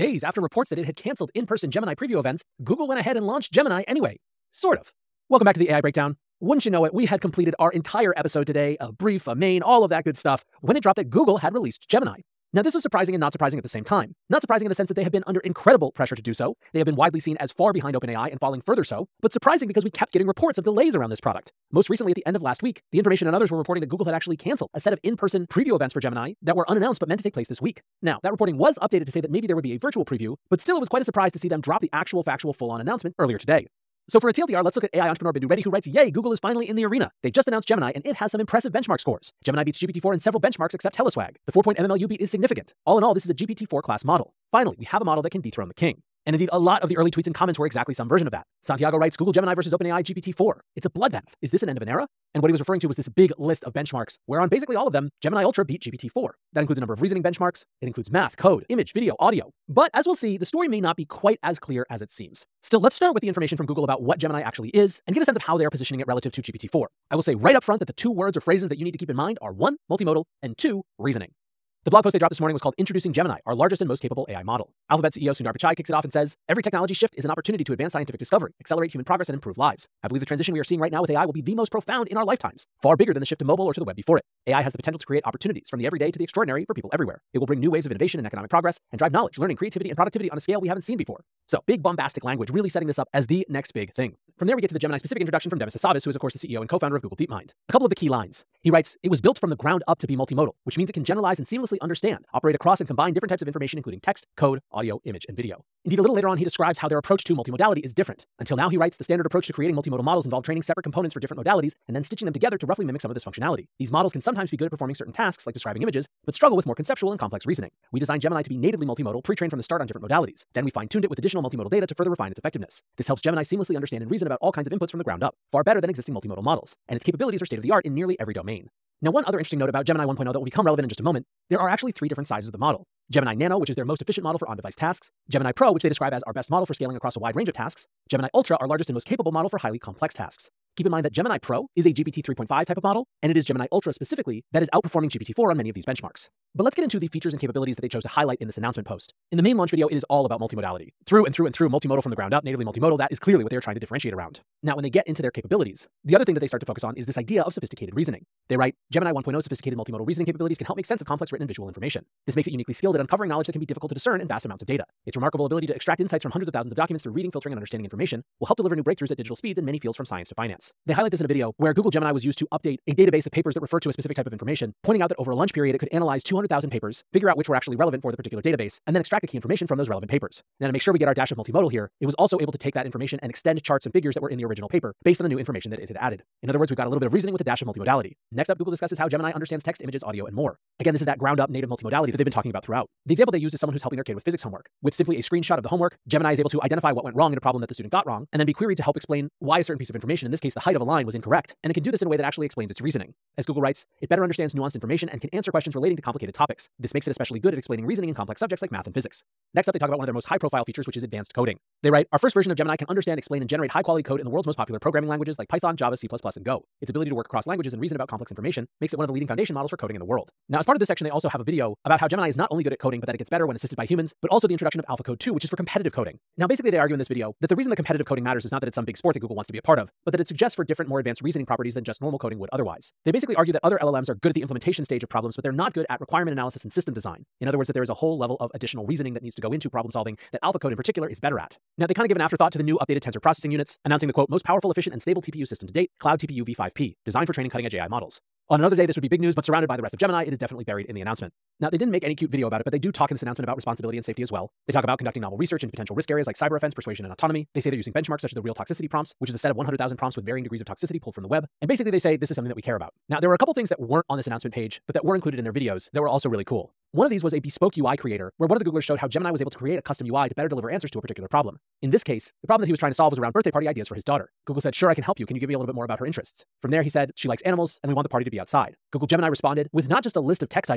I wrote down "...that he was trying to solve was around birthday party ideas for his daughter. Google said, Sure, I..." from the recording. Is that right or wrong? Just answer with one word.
right.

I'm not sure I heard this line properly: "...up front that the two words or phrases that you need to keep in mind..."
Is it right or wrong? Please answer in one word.
right.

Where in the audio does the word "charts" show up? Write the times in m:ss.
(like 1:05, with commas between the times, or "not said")
3:03.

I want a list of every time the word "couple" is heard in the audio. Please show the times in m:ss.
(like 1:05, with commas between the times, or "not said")
1:37, 4:23.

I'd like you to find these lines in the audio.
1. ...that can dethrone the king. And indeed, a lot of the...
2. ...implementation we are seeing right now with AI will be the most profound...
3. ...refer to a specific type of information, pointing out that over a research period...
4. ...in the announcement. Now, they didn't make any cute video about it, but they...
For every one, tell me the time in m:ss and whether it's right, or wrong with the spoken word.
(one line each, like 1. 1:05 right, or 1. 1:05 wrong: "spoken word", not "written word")
1. 0:45 right
2. 1:20 wrong: "transition", not "implementation"
3. 2:53 wrong: "lunch", not "research"
4. 4:10 right.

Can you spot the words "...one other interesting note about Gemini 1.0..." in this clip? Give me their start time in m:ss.
2:09.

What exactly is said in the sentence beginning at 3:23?
As Google writes, it better understands nuanced information and can answer questions relating to complicated topics.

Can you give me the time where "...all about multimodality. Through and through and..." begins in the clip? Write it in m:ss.
2:30.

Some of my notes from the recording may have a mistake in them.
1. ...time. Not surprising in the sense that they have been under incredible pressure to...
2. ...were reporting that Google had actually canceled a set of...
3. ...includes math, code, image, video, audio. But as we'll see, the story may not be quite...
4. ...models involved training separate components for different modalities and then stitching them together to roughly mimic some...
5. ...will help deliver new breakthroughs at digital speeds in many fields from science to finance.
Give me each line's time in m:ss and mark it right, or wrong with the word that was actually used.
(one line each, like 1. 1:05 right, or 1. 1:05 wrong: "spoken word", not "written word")
1. 0:13 right
2. 0:23 right
3. 0:57 right
4. 1:50 right
5. 2:48 right.